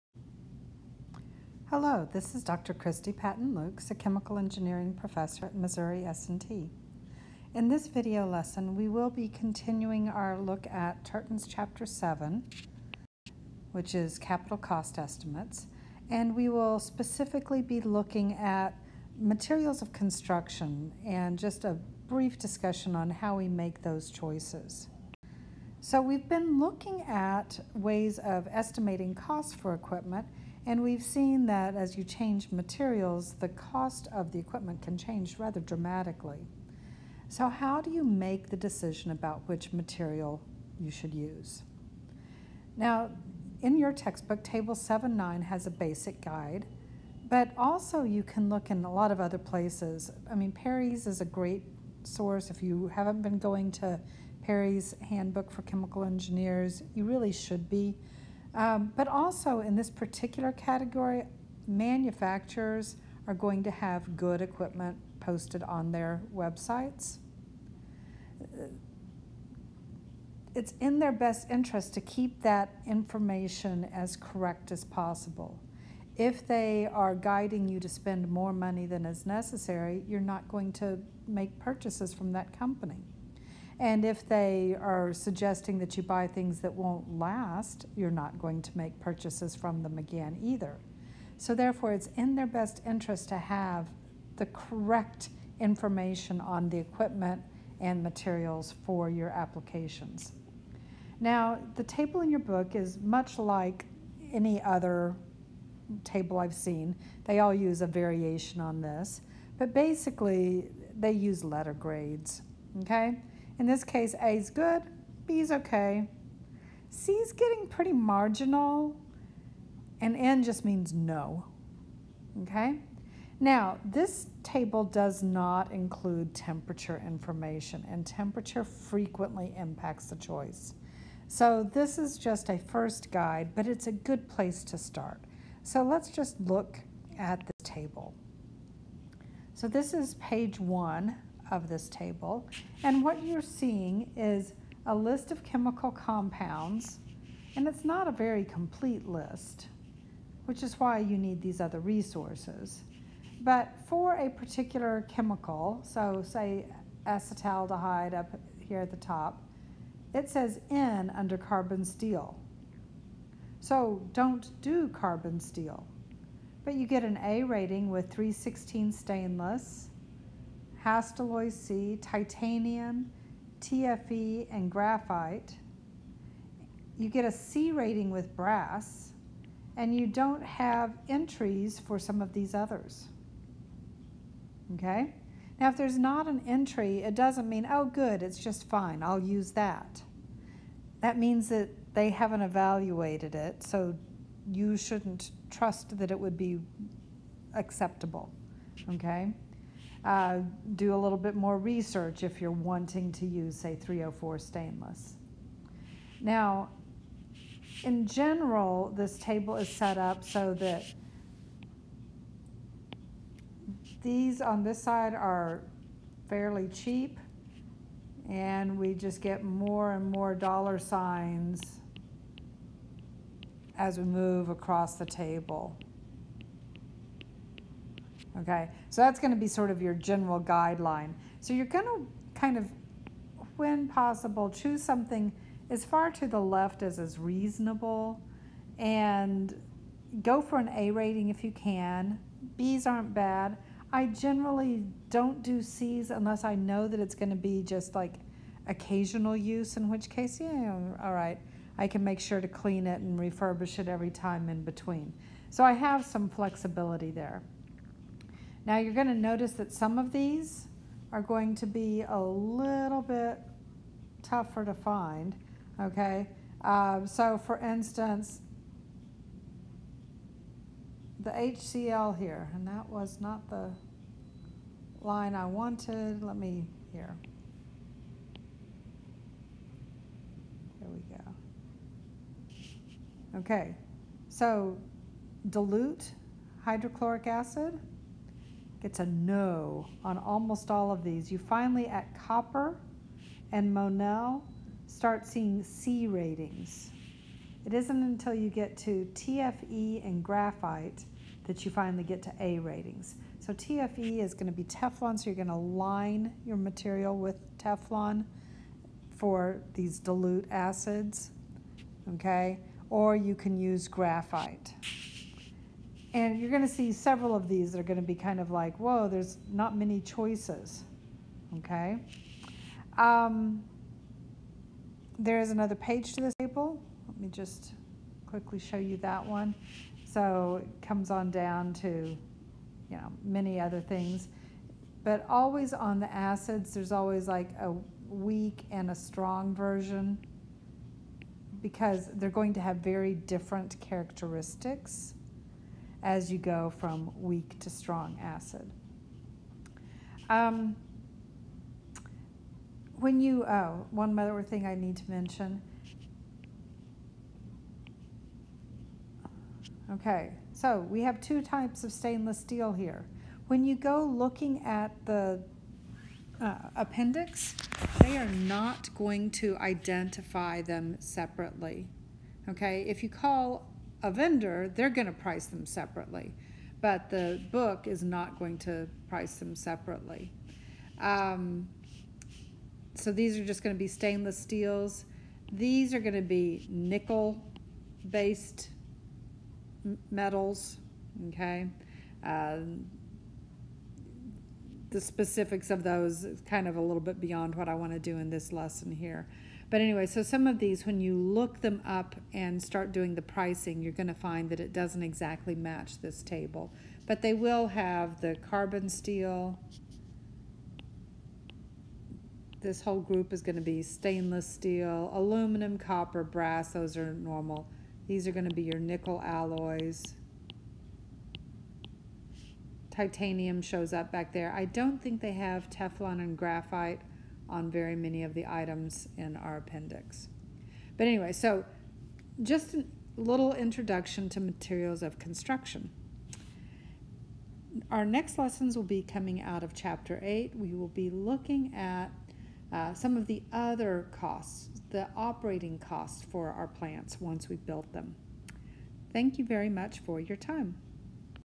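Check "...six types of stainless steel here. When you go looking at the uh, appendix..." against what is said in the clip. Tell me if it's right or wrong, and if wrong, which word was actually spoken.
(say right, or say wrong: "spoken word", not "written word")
wrong: "two", not "six".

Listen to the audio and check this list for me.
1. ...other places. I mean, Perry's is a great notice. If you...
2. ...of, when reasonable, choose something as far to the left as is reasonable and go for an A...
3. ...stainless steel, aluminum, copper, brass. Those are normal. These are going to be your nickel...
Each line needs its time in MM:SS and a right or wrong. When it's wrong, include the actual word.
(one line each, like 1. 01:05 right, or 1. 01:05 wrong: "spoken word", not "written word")
1. 00:49 wrong: "source", not "notice"
2. 03:52 wrong: "possible", not "reasonable"
3. 06:53 right.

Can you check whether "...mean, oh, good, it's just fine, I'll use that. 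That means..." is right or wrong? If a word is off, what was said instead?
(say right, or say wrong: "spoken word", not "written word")
right.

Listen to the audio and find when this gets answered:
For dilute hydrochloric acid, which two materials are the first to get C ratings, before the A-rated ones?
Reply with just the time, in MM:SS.
04:52.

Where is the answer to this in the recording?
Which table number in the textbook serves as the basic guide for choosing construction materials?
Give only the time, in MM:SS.
00:44.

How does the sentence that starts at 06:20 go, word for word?
Um, so these are just going to be stainless steels.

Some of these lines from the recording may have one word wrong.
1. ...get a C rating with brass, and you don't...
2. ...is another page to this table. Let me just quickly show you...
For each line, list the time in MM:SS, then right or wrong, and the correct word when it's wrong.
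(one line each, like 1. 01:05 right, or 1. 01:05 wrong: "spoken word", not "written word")
1. 02:57 right
2. 05:25 right.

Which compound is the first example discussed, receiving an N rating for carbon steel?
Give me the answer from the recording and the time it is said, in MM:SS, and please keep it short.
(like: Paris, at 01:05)
acetaldehyde, at 02:37.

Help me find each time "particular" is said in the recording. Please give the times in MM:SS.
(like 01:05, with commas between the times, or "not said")
00:59, 02:34.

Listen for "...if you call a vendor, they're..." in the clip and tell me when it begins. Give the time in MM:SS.
06:12.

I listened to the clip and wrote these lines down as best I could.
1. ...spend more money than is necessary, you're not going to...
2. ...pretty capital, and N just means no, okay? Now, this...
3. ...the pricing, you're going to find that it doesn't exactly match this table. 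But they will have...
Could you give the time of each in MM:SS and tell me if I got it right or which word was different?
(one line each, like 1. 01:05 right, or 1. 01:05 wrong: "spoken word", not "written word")
1. 01:17 right
2. 01:57 wrong: "marginal", not "capital"
3. 06:43 right.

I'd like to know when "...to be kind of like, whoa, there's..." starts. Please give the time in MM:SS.
05:17.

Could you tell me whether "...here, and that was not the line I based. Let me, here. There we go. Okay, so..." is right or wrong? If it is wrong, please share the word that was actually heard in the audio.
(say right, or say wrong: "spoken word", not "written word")
wrong: "wanted", not "based".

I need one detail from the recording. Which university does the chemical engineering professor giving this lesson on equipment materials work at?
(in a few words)
Missouri S&T.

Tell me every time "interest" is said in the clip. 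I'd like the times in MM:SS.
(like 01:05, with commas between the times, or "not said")
01:11, 01:32.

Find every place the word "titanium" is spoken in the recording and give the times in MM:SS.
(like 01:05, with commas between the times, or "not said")
02:52, 07:02.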